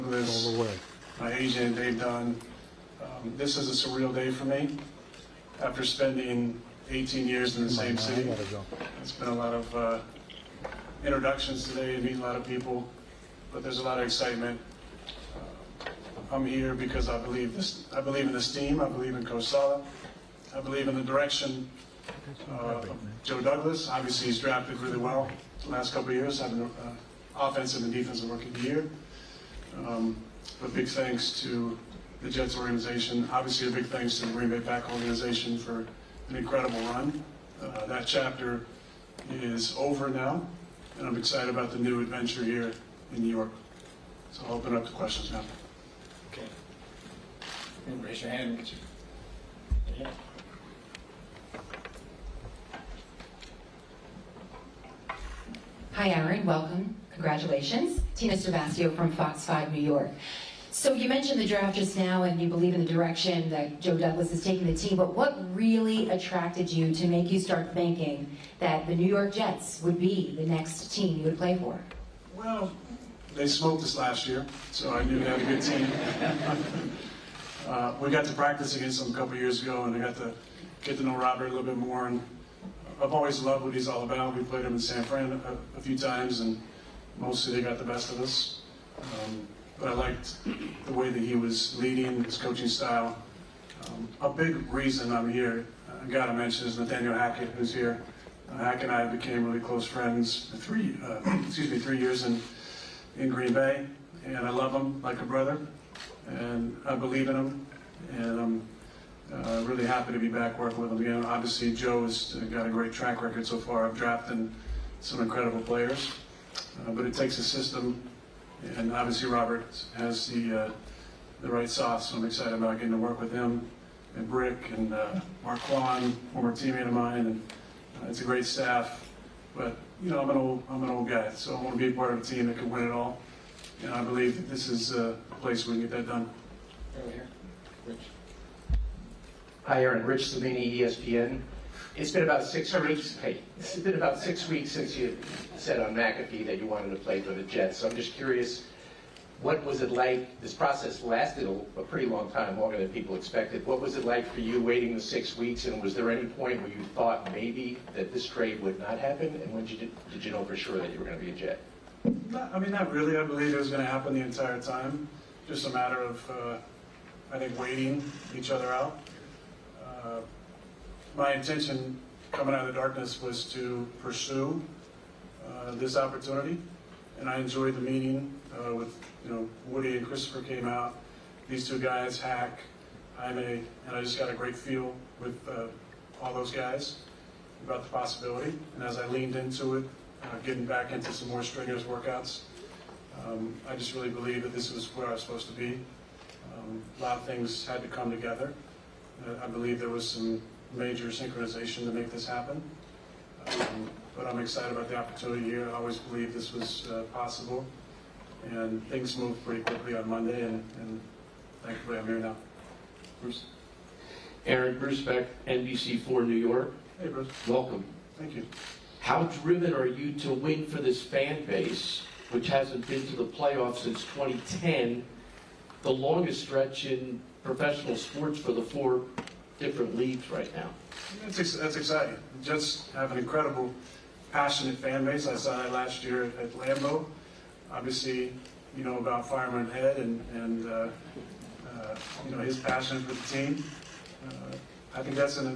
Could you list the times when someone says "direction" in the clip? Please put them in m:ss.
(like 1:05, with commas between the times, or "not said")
0:21, 1:02.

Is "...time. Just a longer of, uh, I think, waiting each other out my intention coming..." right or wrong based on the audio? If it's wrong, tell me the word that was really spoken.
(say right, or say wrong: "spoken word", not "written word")
wrong: "matter", not "longer".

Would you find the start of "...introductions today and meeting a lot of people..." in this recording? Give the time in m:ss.
0:11.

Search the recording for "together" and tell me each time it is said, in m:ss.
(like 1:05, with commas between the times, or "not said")
3:18.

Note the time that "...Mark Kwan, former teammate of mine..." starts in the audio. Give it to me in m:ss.
2:05.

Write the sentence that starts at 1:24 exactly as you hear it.
We played him in San Fran a, a few times and mostly they got the best of us.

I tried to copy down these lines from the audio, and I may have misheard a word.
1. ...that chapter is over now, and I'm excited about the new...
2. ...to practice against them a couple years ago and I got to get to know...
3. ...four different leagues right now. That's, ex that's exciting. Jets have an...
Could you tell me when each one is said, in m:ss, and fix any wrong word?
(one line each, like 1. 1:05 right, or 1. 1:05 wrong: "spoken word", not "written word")
1. 0:37 right
2. 1:18 right
3. 3:48 right.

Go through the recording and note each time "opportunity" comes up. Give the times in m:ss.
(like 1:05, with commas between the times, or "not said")
2:55, 3:24.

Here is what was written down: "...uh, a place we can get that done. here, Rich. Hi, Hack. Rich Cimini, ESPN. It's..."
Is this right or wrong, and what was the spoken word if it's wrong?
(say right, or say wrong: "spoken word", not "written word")
wrong: "Aaron", not "Hack".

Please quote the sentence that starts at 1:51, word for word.
Obviously, Joe's got a great track record so far of drafting some incredible players.